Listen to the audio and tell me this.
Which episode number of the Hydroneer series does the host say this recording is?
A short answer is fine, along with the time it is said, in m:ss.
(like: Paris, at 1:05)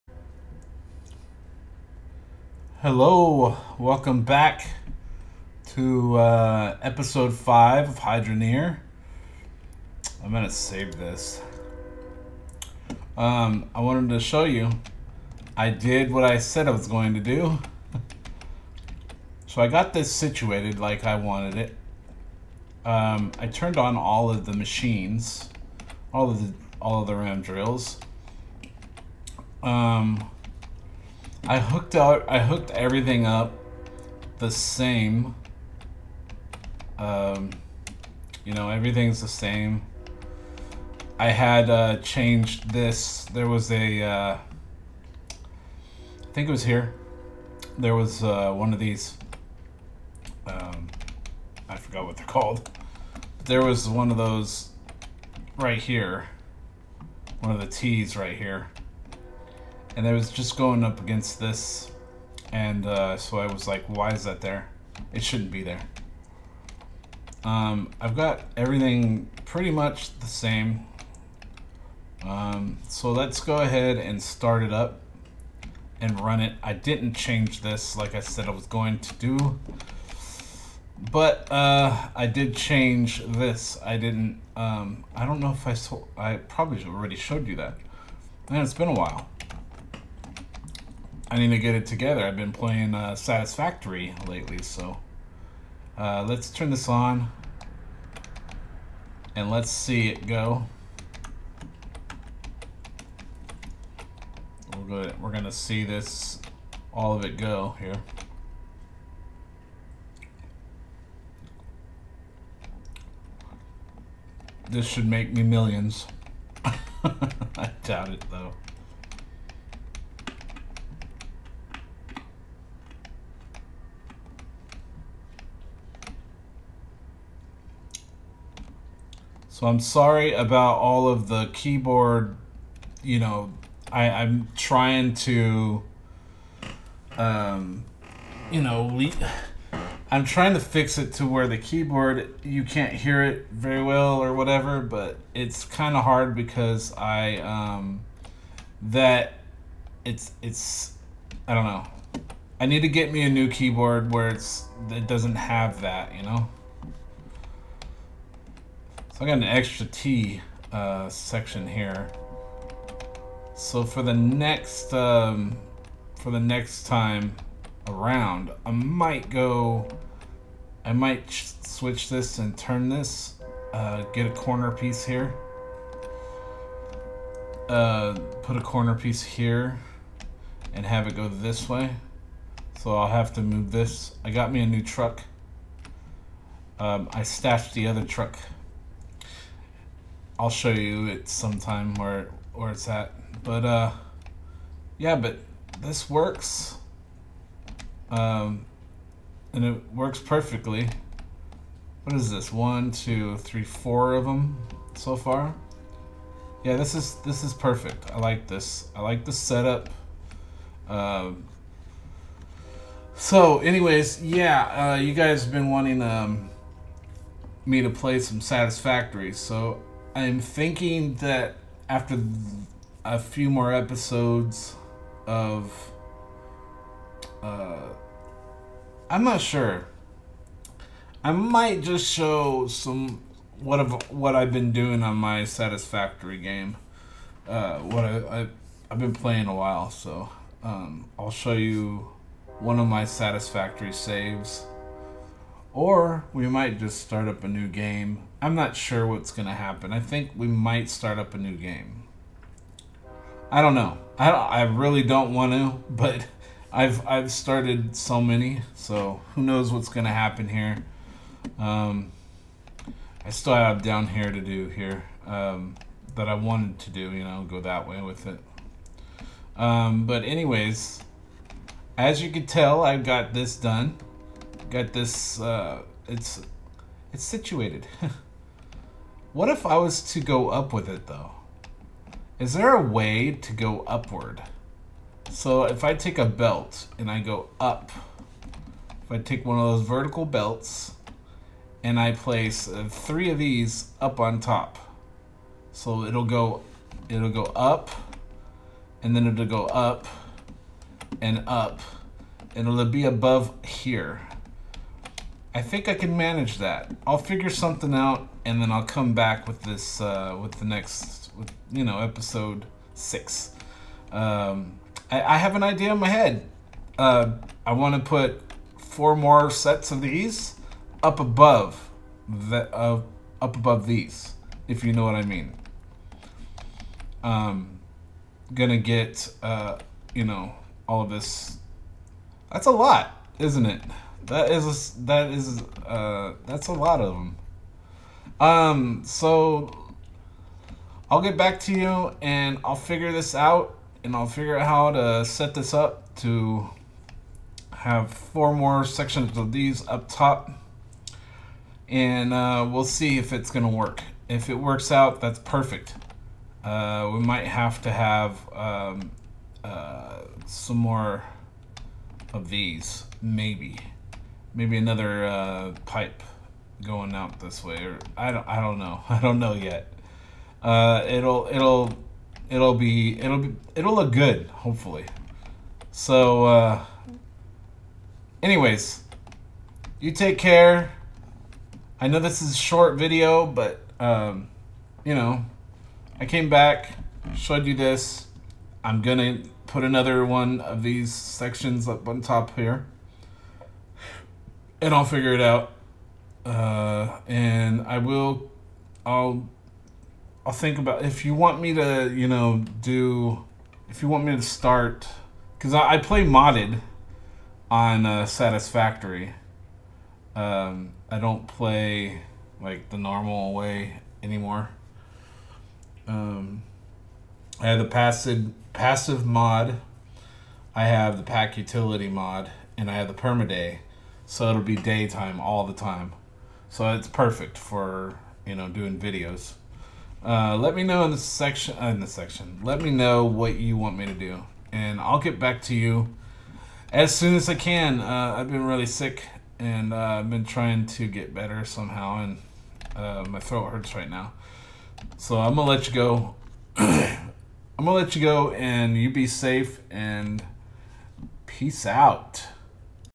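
5, at 0:06.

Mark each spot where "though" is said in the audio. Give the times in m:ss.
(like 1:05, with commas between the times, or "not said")
1:58, 4:41.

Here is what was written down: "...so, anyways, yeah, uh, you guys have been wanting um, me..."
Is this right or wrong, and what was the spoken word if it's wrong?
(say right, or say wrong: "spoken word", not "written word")
right.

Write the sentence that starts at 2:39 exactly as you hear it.
I got an extra T uh, section here.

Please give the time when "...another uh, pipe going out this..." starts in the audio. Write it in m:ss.
6:04.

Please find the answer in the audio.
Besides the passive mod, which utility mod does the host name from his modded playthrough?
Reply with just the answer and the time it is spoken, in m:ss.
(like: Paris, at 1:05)
Pak Utility mod, at 7:01.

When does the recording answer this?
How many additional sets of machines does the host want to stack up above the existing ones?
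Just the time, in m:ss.
5:18.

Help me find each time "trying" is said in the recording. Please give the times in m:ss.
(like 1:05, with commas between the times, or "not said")
2:14, 2:20, 7:20.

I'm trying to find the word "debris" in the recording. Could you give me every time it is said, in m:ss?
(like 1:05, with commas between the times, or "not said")
not said.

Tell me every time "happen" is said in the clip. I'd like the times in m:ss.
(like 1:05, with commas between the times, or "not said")
4:09, 4:20.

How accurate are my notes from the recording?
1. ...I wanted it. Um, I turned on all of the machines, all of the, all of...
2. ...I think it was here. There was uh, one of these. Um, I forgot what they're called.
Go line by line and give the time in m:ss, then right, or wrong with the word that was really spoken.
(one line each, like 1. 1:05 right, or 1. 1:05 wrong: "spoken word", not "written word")
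1. 0:21 right
2. 0:45 right.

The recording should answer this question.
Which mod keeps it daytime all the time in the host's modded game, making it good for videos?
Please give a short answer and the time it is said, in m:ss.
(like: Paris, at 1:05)
permaday, at 7:03.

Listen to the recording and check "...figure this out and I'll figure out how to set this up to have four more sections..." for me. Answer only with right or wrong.
right.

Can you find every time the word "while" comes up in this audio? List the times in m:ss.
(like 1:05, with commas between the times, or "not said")
1:28, 3:59.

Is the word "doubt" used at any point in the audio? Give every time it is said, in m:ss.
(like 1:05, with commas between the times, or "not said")
1:57.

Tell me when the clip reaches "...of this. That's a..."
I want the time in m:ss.
5:31.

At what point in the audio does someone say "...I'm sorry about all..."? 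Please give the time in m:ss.
2:09.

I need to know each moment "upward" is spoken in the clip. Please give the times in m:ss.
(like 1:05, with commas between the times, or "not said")
4:43.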